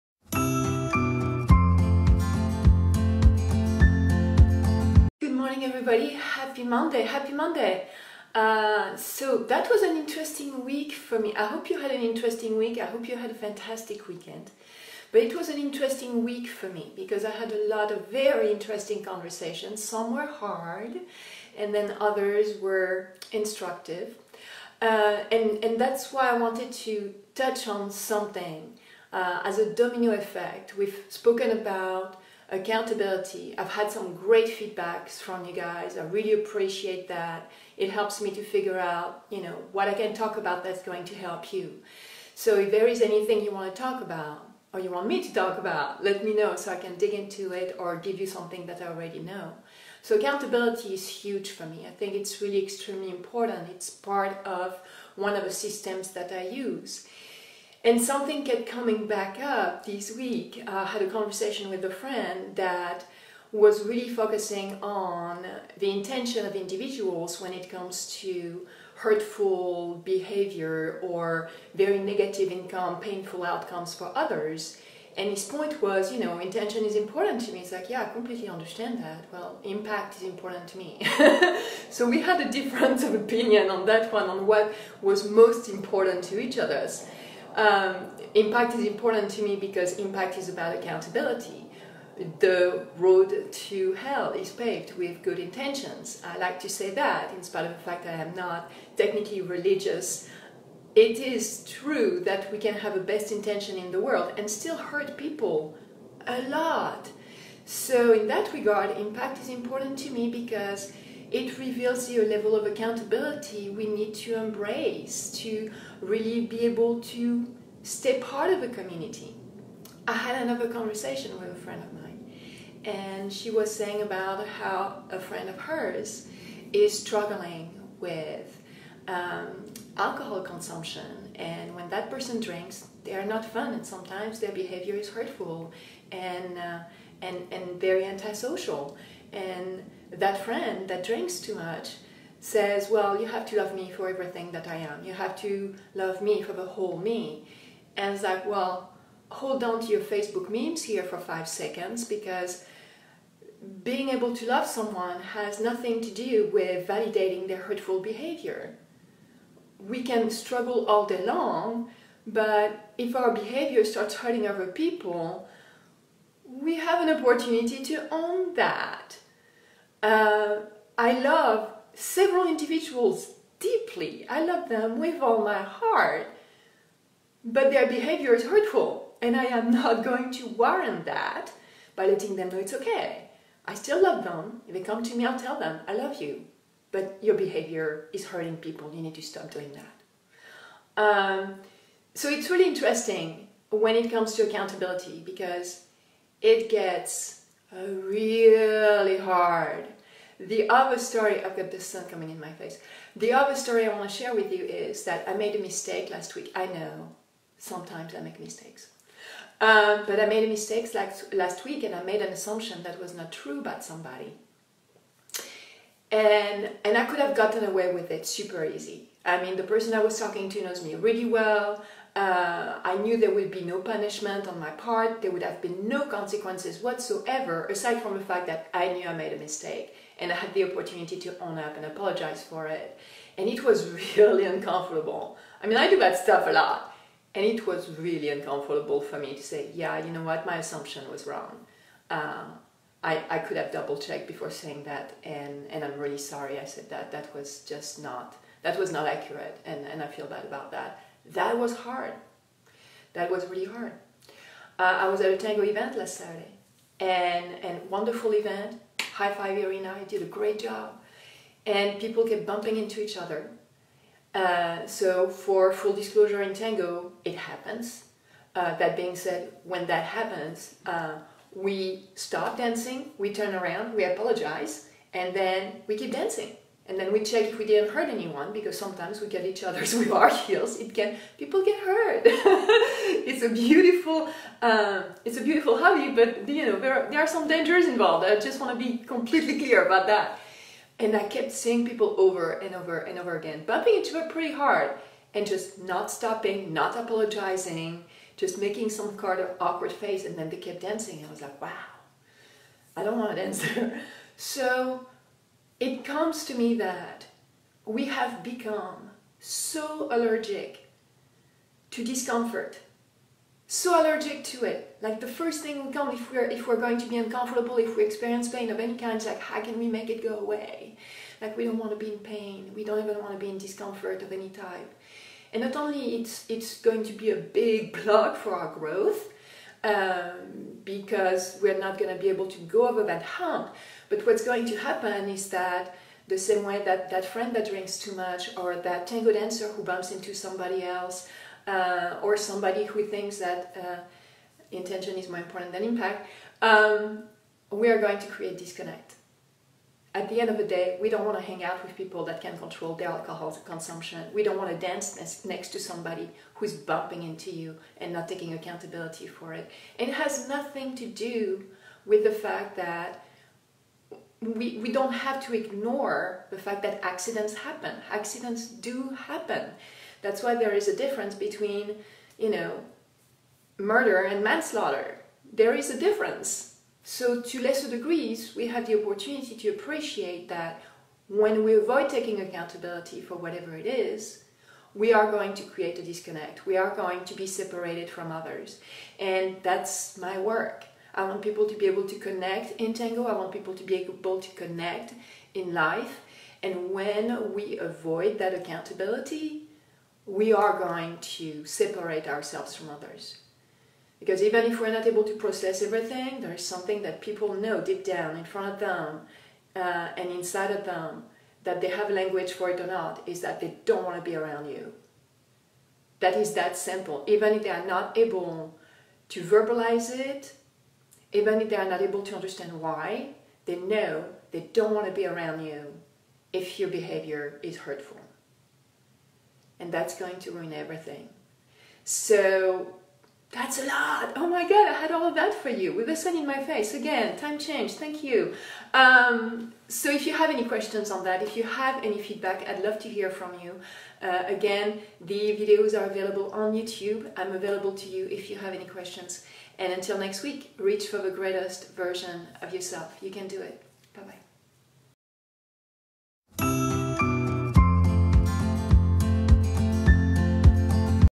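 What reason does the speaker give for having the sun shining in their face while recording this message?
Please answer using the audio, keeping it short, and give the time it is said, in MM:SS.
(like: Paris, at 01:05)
Time change, at 07:17.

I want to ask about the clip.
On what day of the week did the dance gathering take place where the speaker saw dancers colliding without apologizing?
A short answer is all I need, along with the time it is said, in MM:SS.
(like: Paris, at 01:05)
Saturday, at 04:16.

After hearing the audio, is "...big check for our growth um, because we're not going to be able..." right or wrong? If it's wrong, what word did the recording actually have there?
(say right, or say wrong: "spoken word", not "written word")
wrong: "block", not "check".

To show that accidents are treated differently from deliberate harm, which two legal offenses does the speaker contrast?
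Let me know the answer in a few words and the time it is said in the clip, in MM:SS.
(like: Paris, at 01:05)
Murder and manslaughter, at 06:13.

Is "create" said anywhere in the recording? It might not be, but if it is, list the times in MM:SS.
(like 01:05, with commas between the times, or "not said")
05:48, 06:25.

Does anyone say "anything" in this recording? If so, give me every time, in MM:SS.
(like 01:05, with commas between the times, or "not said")
00:43.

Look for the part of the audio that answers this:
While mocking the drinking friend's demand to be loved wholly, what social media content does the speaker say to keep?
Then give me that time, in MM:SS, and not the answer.
02:30.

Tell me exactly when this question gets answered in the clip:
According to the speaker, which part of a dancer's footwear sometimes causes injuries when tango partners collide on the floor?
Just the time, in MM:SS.
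04:40.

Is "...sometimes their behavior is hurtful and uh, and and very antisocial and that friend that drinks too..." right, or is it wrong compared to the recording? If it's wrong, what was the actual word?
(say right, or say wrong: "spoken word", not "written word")
right.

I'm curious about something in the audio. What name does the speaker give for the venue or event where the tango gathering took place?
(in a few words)
High Five Arena.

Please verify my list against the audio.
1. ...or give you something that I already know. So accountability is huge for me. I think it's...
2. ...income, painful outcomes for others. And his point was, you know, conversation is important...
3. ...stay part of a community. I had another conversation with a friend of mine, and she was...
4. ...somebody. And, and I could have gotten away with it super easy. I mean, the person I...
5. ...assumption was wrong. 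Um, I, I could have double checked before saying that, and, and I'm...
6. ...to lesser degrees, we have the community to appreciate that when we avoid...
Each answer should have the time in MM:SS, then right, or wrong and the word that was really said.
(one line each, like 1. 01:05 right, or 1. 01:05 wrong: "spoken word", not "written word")
1. 00:47 right
2. 01:12 wrong: "intention", not "conversation"
3. 01:57 right
4. 03:33 right
5. 04:00 right
6. 06:17 wrong: "opportunity", not "community".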